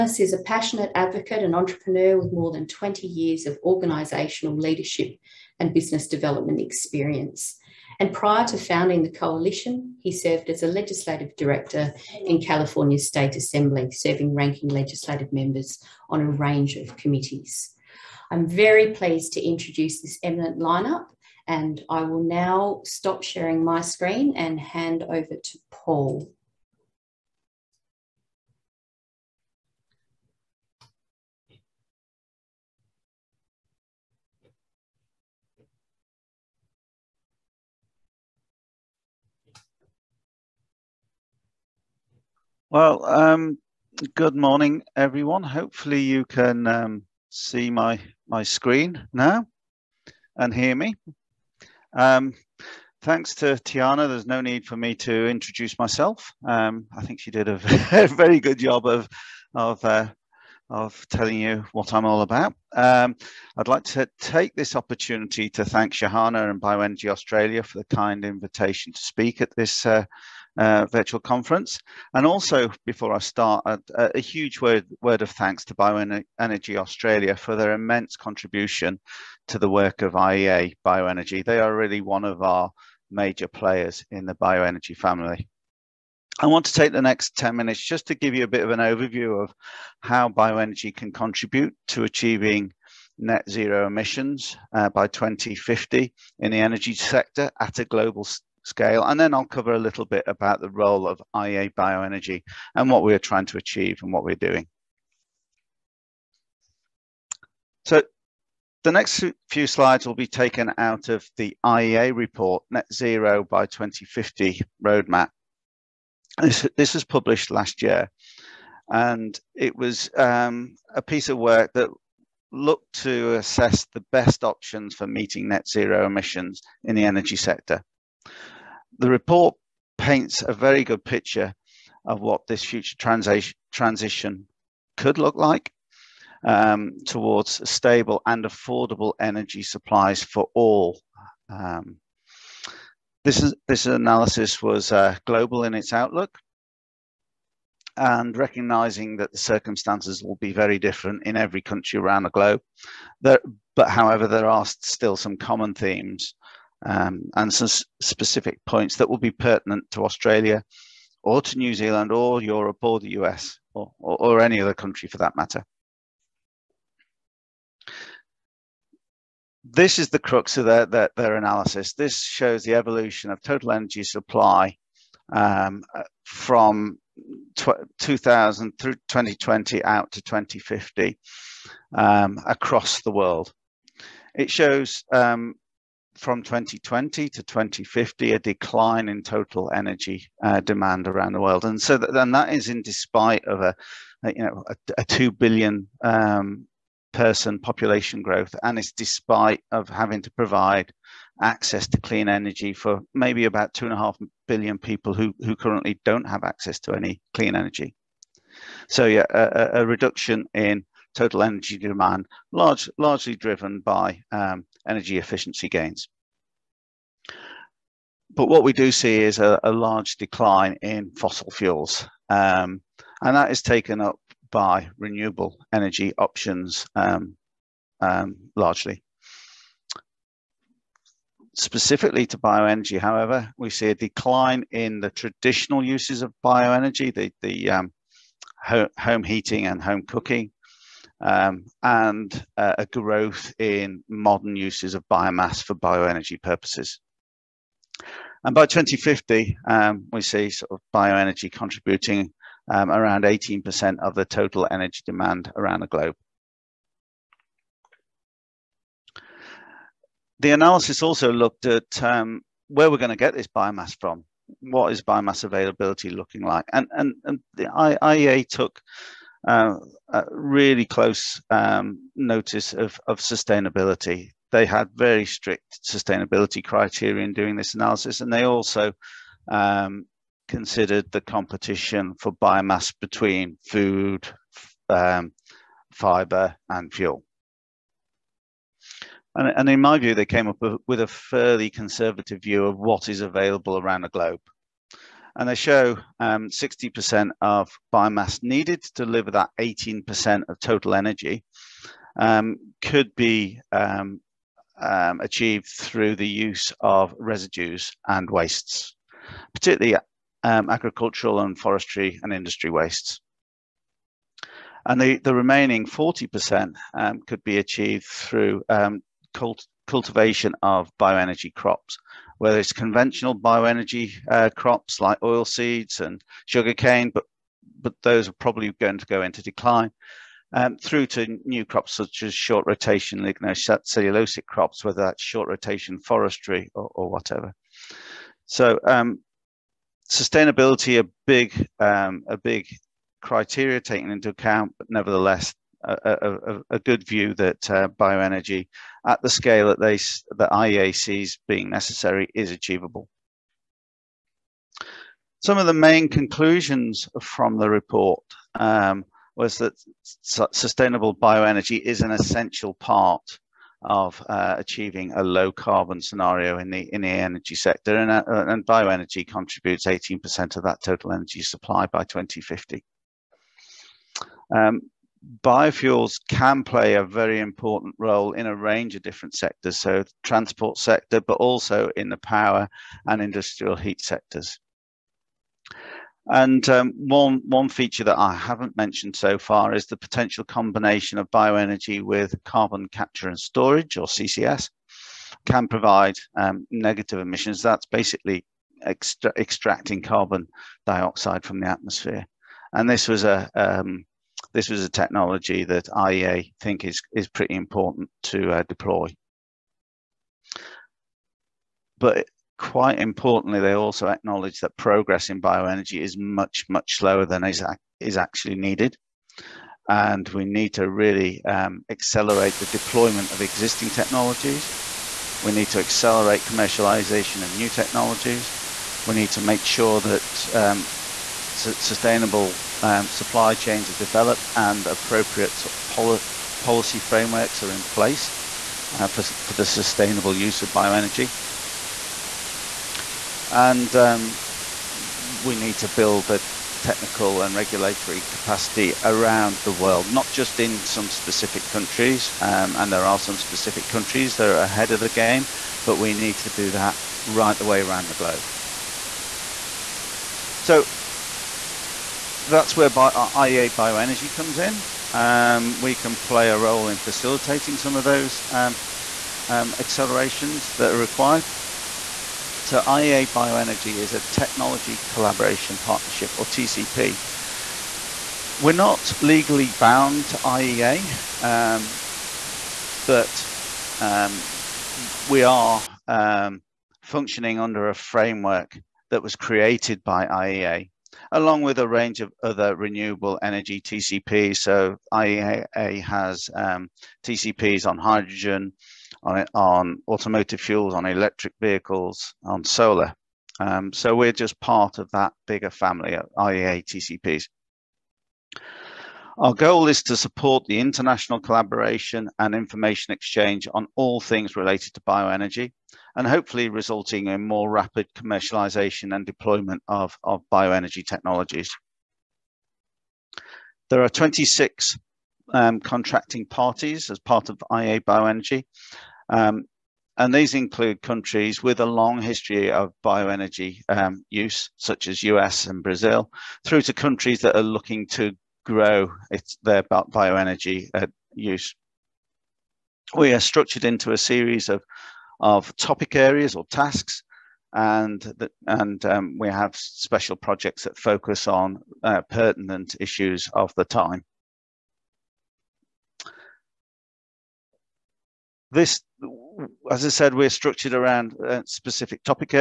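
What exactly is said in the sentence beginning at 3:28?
So yeah, a, a reduction in total energy demand, large, largely driven by um, energy efficiency gains.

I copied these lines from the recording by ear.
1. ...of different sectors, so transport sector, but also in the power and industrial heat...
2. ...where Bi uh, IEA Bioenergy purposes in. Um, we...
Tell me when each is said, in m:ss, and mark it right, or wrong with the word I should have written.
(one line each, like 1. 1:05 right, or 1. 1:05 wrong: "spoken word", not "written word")
1. 6:18 right
2. 7:42 wrong: "comes", not "purposes".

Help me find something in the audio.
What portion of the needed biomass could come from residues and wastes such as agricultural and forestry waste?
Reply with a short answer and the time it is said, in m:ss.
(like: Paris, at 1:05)
60%, at 4:56.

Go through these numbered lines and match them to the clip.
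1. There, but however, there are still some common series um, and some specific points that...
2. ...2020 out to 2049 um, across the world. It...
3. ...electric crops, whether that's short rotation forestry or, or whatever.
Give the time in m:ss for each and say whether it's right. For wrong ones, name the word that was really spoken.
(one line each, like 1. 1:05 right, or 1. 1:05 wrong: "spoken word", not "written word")
1. 2:33 wrong: "themes", not "series"
2. 2:58 wrong: "2050", not "2049"
3. 5:33 wrong: "lignocellulosic", not "electric".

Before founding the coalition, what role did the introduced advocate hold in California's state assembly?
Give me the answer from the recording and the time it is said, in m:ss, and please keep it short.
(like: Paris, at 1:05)
Legislative director, at 0:10.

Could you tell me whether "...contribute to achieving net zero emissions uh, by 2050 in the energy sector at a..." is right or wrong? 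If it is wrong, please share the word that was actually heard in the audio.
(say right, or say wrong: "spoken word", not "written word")
right.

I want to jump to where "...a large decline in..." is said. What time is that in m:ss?
3:39.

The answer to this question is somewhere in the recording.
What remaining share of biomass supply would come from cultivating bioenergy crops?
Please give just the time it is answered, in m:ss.
5:15.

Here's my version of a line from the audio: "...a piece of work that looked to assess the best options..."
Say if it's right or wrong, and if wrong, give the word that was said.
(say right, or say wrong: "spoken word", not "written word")
right.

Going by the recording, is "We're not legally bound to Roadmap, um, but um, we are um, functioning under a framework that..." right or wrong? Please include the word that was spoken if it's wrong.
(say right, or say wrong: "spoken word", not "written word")
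wrong: "IEA", not "Roadmap".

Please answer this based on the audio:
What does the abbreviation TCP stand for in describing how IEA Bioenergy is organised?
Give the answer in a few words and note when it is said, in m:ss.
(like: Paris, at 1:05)
Technology collaboration partnership, at 7:54.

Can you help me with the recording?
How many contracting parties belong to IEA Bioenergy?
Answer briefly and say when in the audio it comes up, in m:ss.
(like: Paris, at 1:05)
26, at 8:44.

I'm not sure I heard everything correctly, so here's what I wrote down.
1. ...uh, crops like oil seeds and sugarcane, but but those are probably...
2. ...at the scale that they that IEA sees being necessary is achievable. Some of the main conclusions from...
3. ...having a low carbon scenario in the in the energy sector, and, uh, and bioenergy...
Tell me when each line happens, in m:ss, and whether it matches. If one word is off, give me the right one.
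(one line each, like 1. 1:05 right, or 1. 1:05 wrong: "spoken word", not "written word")
1. 5:24 right
2. 5:49 right
3. 6:04 wrong: "achieving", not "having".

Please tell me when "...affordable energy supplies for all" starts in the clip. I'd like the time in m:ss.
2:18.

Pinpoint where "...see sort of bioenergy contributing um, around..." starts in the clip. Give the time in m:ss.
4:10.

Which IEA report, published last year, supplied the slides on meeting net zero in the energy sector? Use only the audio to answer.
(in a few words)
Net Zero by 2050 Roadmap.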